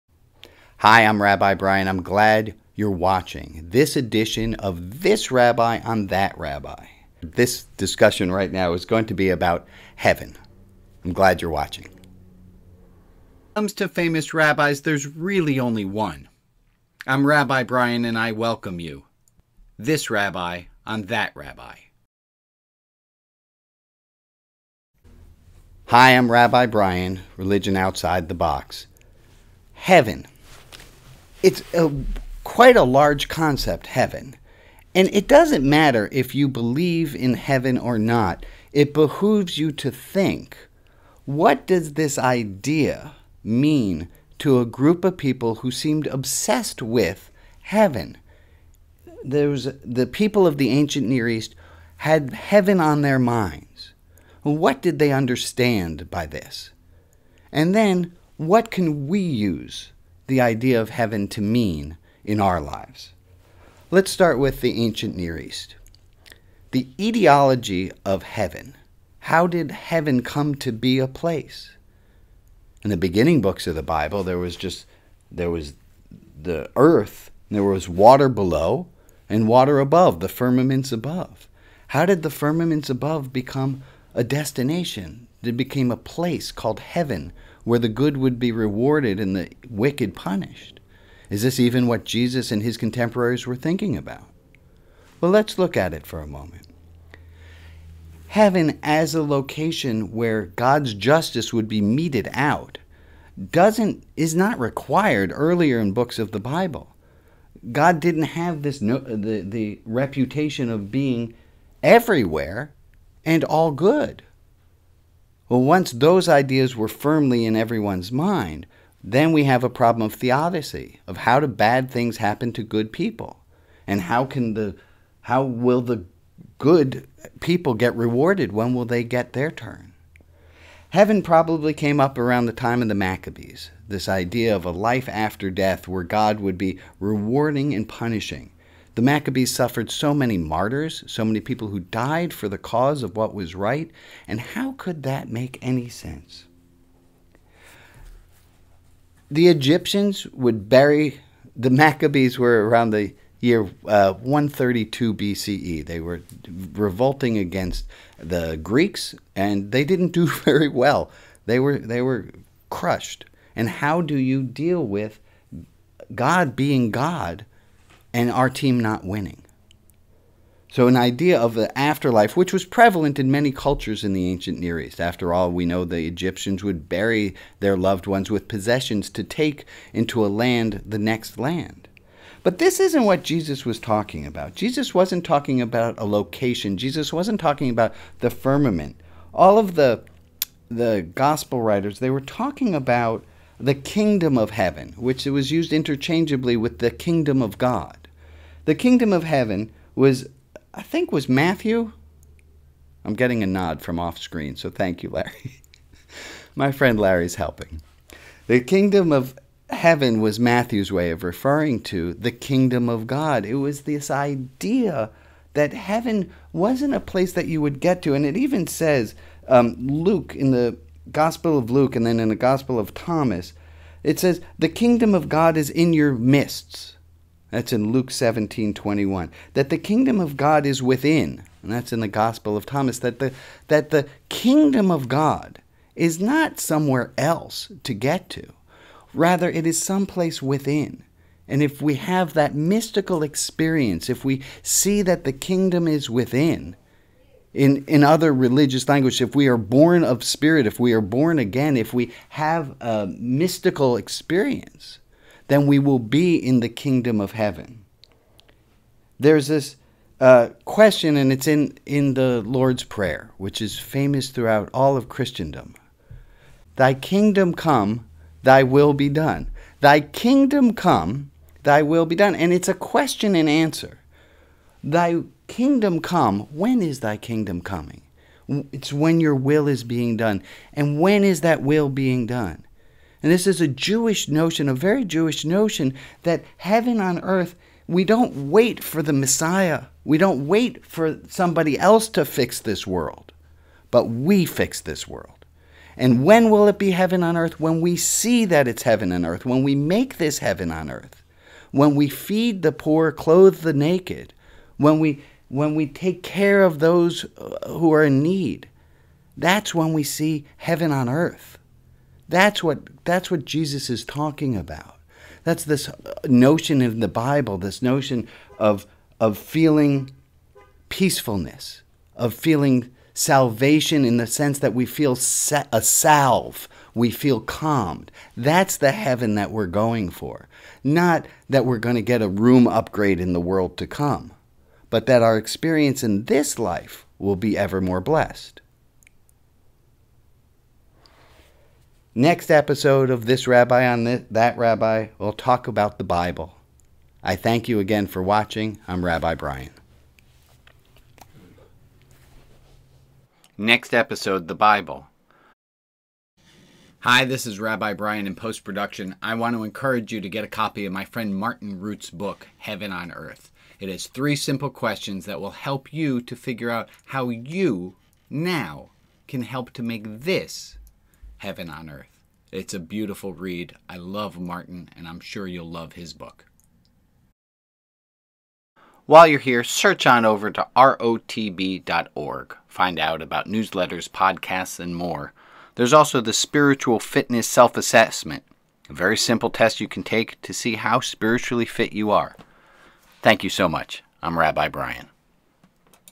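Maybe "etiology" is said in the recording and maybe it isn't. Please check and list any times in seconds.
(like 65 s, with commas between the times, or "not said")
66 s.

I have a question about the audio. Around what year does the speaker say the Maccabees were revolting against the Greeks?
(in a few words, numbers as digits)
132 BCE.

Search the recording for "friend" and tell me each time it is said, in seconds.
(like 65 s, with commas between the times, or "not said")
206 s, 361 s.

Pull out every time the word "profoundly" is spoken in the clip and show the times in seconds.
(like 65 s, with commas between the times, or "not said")
not said.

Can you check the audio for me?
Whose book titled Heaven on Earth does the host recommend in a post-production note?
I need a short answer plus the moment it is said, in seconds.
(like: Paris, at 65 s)
Martin Rutte, at 361 s.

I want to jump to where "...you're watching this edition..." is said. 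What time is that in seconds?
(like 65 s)
2 s.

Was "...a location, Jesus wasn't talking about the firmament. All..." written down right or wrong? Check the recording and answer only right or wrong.
right.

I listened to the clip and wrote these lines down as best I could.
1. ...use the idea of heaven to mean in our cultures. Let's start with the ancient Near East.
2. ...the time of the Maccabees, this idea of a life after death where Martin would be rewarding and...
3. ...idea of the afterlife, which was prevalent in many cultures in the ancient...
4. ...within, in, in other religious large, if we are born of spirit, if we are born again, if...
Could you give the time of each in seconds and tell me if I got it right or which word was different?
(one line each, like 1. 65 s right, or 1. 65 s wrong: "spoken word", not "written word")
1. 59 s wrong: "lives", not "cultures"
2. 132 s wrong: "God", not "Martin"
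3. 170 s right
4. 246 s wrong: "language", not "large".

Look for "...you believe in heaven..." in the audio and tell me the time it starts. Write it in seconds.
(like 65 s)
36 s.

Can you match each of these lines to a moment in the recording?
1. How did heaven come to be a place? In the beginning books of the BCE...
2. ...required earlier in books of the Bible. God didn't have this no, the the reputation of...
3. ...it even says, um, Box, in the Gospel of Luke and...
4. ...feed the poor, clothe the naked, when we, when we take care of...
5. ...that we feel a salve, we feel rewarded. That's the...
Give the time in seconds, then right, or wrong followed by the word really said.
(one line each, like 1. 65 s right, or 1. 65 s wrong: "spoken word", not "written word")
1. 69 s wrong: "Bible", not "BCE"
2. 104 s right
3. 218 s wrong: "Luke", not "Box"
4. 302 s right
5. 324 s wrong: "calmed", not "rewarded".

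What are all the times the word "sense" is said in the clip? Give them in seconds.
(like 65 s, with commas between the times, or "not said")
145 s, 324 s.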